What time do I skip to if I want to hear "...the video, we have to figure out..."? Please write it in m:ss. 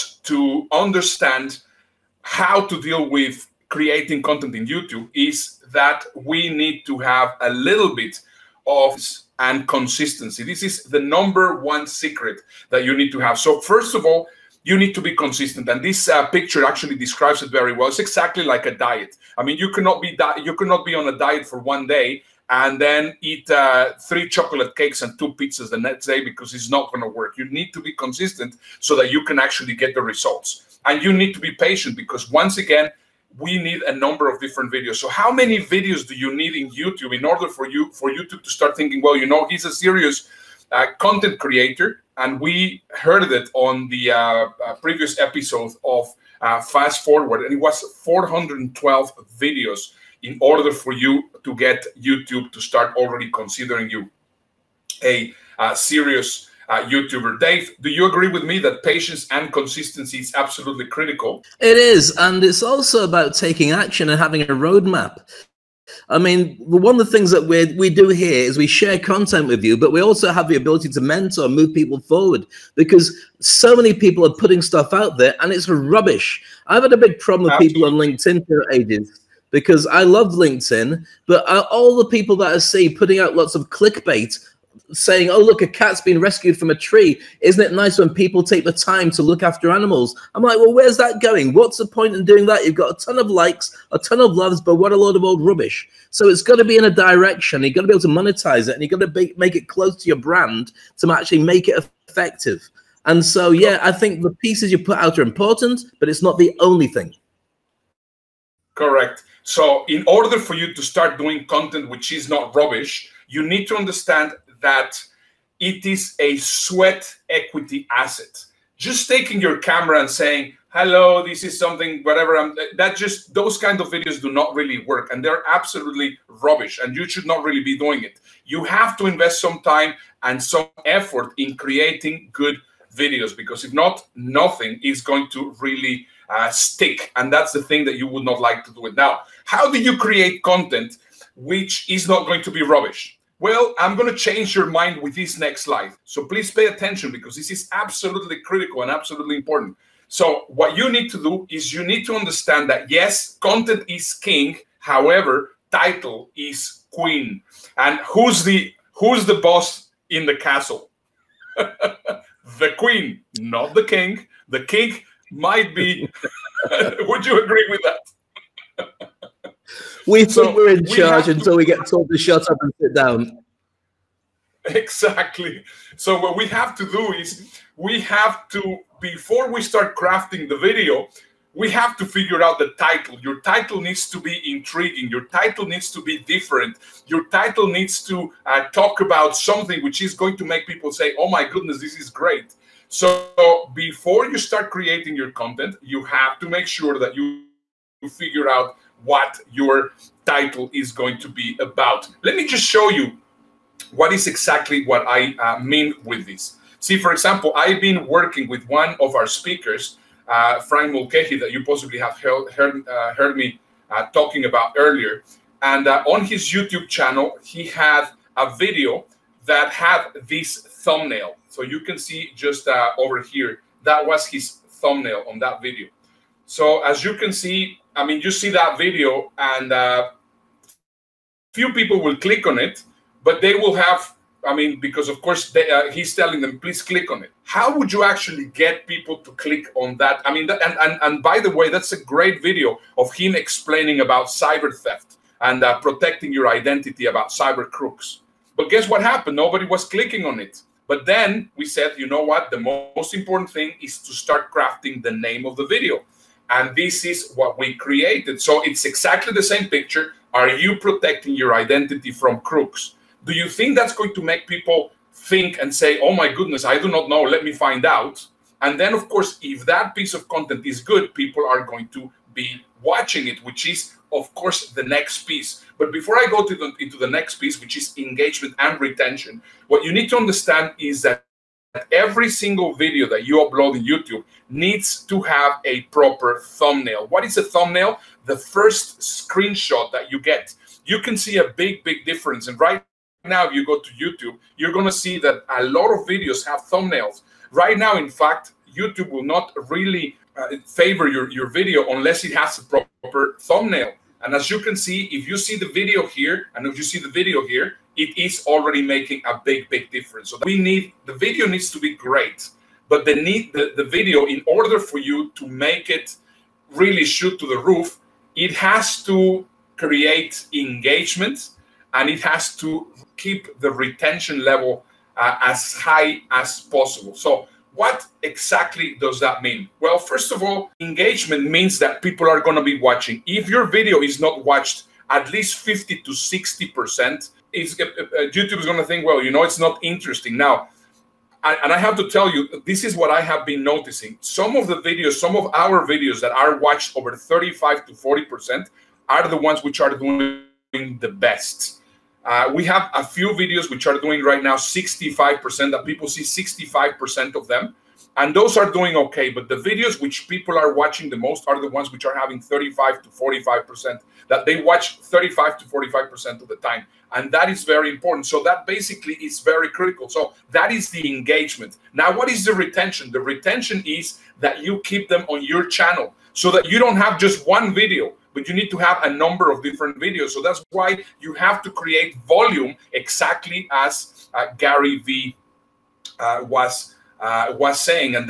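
3:00.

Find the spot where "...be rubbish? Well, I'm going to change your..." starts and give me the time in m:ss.
2:22.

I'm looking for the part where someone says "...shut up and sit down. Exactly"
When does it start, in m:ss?
2:52.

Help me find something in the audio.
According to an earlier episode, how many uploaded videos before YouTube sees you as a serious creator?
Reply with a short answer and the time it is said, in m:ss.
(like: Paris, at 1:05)
412, at 0:48.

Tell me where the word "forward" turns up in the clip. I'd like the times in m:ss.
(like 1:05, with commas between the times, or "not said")
0:47, 1:11.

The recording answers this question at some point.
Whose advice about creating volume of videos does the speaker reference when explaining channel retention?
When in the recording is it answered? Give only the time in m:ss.
6:24.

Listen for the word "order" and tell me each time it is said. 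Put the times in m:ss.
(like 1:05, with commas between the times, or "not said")
0:37, 0:50, 1:50, 5:14.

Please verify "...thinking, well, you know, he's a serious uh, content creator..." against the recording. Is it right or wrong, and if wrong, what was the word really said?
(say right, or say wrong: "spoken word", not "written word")
right.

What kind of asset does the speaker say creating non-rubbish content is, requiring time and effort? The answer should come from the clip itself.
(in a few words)
Sweat equity asset.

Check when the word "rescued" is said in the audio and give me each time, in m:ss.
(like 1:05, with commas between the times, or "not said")
1:26.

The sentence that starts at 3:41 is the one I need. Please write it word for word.
So you can see just uh, over here, that was his thumbnail on that video.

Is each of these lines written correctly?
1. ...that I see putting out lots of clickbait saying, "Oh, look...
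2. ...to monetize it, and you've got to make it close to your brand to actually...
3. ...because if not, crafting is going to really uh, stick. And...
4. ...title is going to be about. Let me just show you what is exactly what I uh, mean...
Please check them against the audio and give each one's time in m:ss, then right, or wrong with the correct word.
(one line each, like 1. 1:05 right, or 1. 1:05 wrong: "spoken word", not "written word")
1. 1:22 right
2. 1:38 right
3. 2:13 wrong: "nothing", not "crafting"
4. 3:20 right.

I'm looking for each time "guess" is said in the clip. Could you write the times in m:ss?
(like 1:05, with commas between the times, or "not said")
4:08.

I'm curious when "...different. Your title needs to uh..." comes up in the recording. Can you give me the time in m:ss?
3:06.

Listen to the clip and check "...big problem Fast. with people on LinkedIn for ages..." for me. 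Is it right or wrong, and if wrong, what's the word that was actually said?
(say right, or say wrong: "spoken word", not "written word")
wrong: "Absolutely", not "Fast".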